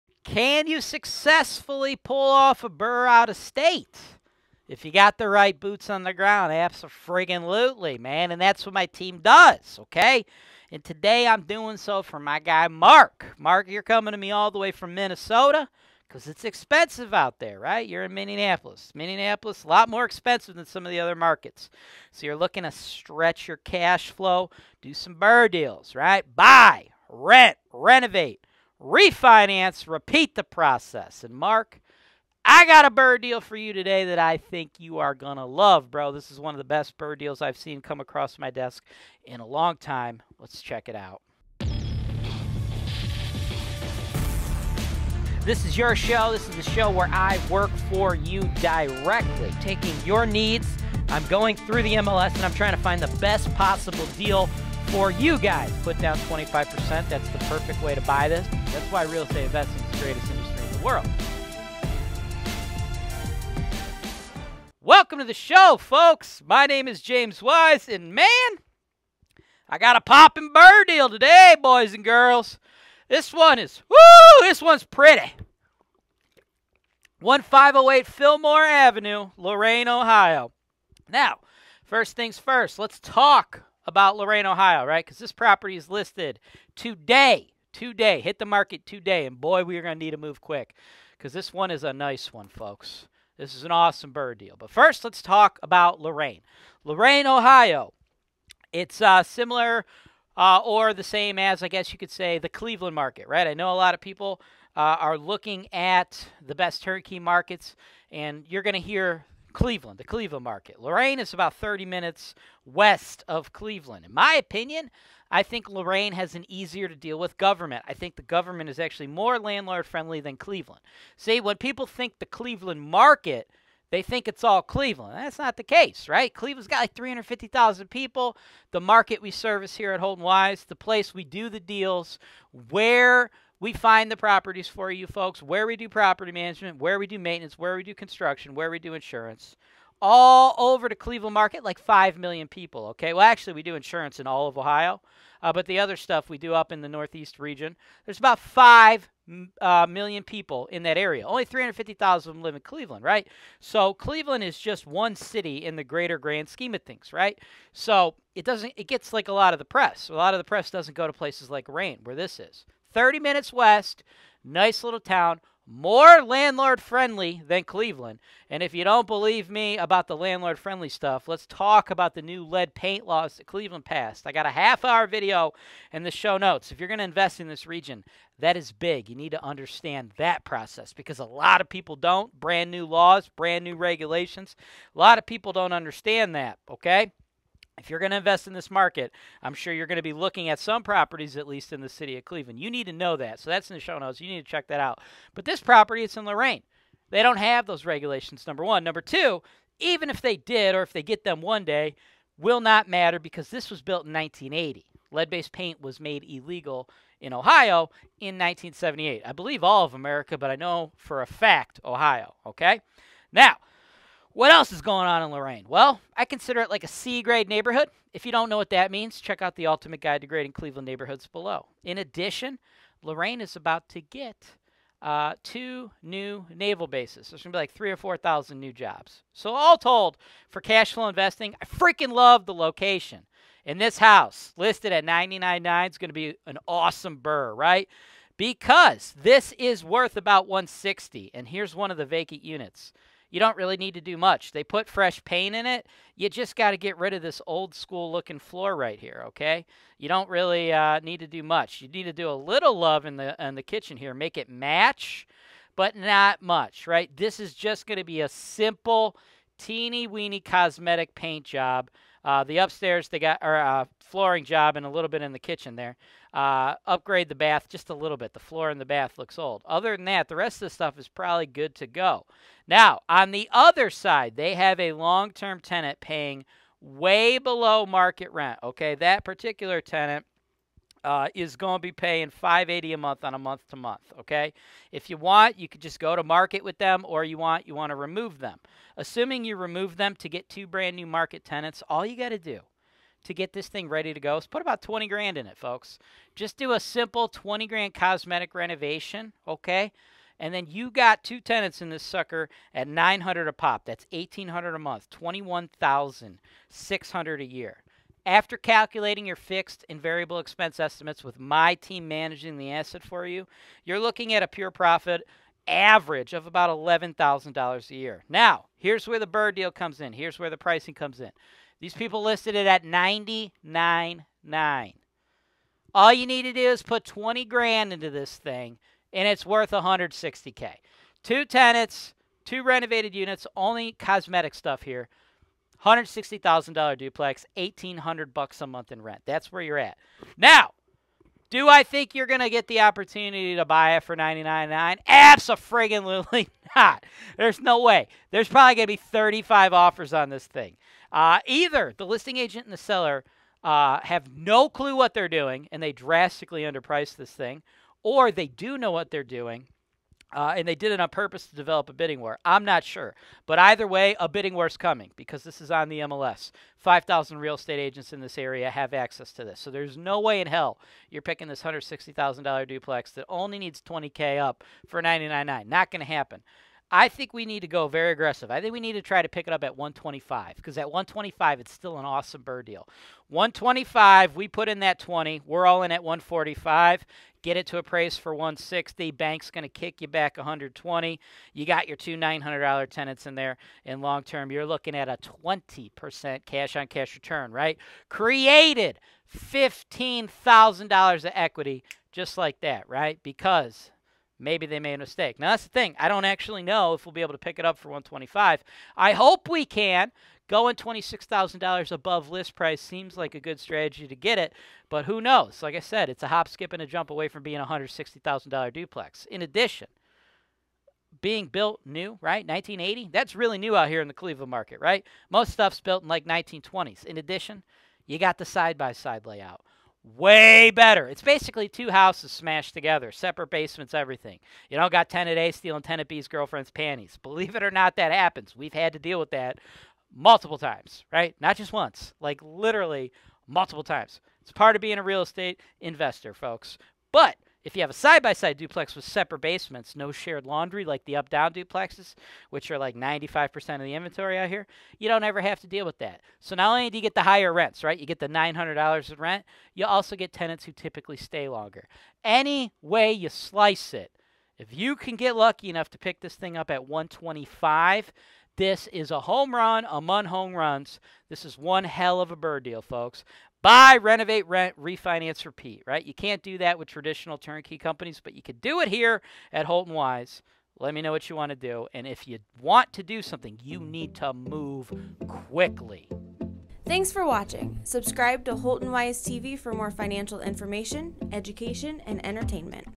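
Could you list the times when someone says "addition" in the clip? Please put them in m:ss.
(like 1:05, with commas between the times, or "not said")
3:41, 6:59, 7:07.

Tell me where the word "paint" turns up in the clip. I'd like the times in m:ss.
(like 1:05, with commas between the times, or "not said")
2:52, 3:25, 4:05, 4:21.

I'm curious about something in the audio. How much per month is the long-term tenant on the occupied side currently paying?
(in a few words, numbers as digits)
$580.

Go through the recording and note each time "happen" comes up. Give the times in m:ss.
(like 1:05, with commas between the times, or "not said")
6:16, 7:18.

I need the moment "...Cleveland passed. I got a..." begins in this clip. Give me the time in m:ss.
2:53.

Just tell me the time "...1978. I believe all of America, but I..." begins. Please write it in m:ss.
3:28.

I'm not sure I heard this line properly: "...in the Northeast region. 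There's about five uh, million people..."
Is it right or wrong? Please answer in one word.
right.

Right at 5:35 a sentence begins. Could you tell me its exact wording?
$160,000 duplex, 1800 bucks a month in rent.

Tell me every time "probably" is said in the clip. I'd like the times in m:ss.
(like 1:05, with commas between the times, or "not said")
4:31, 5:48.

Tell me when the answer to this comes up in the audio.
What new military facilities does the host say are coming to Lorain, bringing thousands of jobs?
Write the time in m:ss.
3:45.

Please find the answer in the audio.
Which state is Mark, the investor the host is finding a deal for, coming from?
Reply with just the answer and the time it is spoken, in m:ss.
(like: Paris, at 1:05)
Minnesota, at 0:14.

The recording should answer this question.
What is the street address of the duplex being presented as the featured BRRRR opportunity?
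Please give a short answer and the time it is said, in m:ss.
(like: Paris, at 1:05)
1508 Fillmore Avenue, at 1:17.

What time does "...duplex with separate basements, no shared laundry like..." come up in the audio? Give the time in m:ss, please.
7:28.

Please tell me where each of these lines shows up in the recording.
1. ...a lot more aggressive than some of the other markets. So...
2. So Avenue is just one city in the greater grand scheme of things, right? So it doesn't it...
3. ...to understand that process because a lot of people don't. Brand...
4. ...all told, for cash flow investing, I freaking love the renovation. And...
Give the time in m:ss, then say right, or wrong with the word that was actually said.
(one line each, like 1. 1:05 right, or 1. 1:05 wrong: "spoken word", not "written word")
1. 0:19 wrong: "expensive", not "aggressive"
2. 2:33 wrong: "Cleveland", not "Avenue"
3. 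2:59 right
4. 3:49 wrong: "location", not "renovation".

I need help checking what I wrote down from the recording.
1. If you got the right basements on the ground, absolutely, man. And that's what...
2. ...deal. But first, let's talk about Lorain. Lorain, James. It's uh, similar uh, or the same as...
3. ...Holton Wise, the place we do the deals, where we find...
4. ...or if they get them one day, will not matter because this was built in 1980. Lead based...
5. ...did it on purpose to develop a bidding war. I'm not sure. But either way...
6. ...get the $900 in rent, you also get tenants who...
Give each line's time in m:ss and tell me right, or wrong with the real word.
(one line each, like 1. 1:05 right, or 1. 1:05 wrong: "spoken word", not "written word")
1. 0:04 wrong: "boots", not "basements"
2. 1:34 wrong: "Ohio", not "James"
3. 2:09 right
4. 3:20 right
5. 6:00 right
6. 7:38 right.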